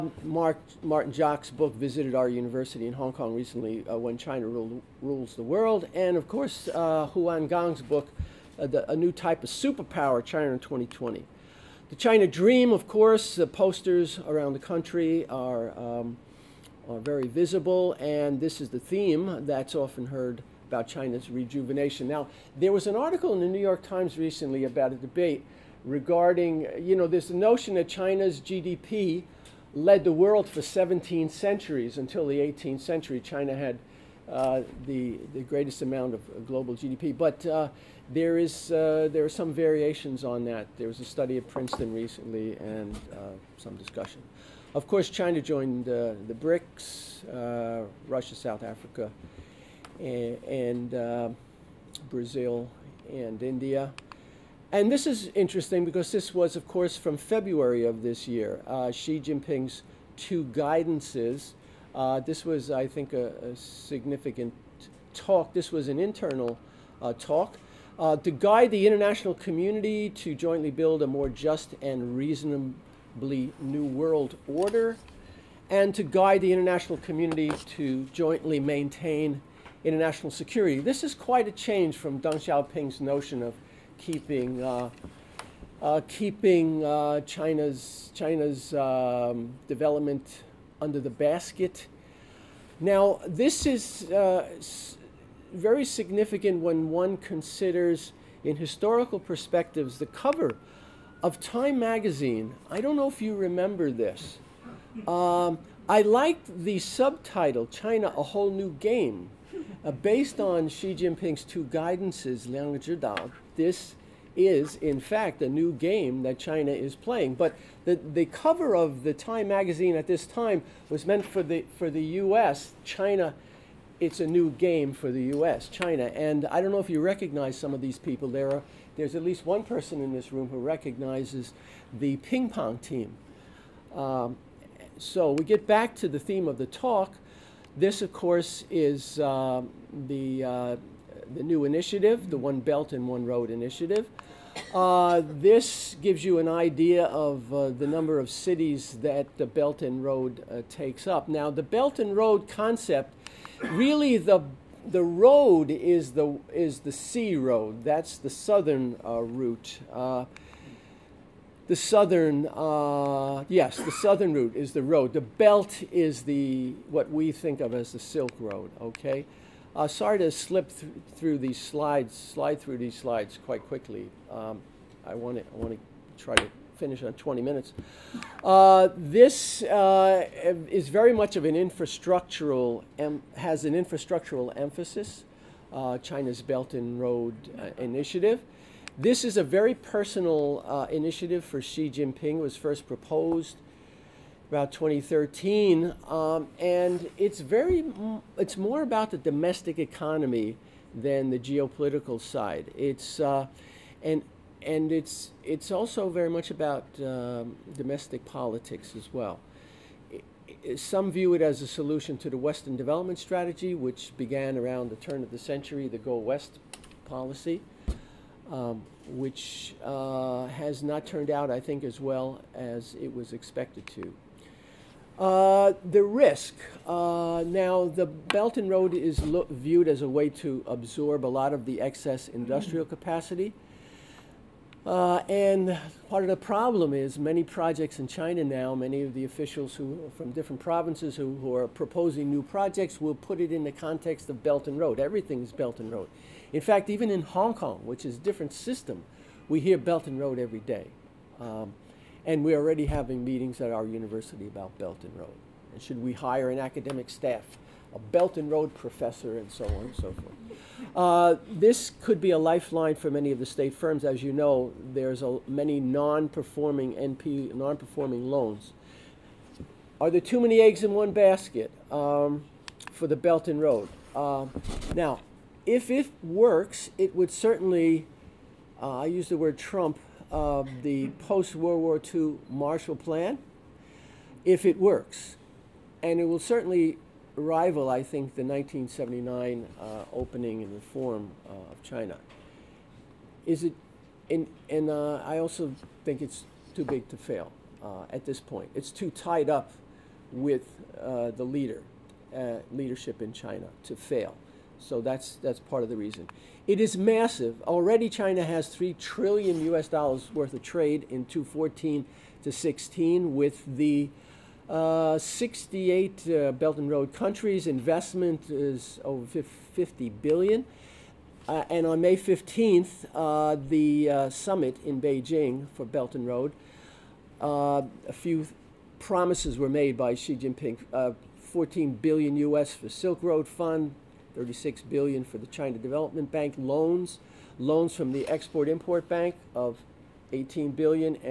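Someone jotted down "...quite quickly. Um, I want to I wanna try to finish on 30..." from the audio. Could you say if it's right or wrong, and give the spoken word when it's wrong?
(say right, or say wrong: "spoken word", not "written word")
wrong: "20", not "30".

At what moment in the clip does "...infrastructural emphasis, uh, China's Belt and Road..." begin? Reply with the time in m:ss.
3:03.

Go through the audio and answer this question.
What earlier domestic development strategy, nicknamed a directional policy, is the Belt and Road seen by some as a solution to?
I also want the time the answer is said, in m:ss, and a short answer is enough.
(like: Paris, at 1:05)
Go West policy, at 3:35.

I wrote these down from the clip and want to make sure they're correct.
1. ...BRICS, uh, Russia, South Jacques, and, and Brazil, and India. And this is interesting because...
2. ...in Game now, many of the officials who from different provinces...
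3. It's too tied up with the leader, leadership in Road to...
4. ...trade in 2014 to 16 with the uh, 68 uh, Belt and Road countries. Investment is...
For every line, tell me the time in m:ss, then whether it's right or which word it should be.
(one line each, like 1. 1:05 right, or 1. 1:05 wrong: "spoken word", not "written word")
1. 0:46 wrong: "Africa", not "Jacques"
2. 3:58 wrong: "China", not "Game"
3. 4:58 wrong: "China", not "Road"
4. 5:10 right.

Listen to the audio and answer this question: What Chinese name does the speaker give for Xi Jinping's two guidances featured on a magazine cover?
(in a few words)
Liang Zhidao.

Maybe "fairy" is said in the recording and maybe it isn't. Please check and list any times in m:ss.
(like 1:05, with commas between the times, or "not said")
not said.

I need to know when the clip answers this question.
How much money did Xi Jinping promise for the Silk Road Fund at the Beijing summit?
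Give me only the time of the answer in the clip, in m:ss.
5:31.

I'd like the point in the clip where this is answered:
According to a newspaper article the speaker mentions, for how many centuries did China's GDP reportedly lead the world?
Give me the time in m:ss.
0:30.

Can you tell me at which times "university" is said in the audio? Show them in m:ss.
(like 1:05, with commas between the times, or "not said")
0:02, 4:13.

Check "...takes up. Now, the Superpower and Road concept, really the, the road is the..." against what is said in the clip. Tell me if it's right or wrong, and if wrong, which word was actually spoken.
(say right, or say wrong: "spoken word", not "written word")
wrong: "Belt", not "Superpower".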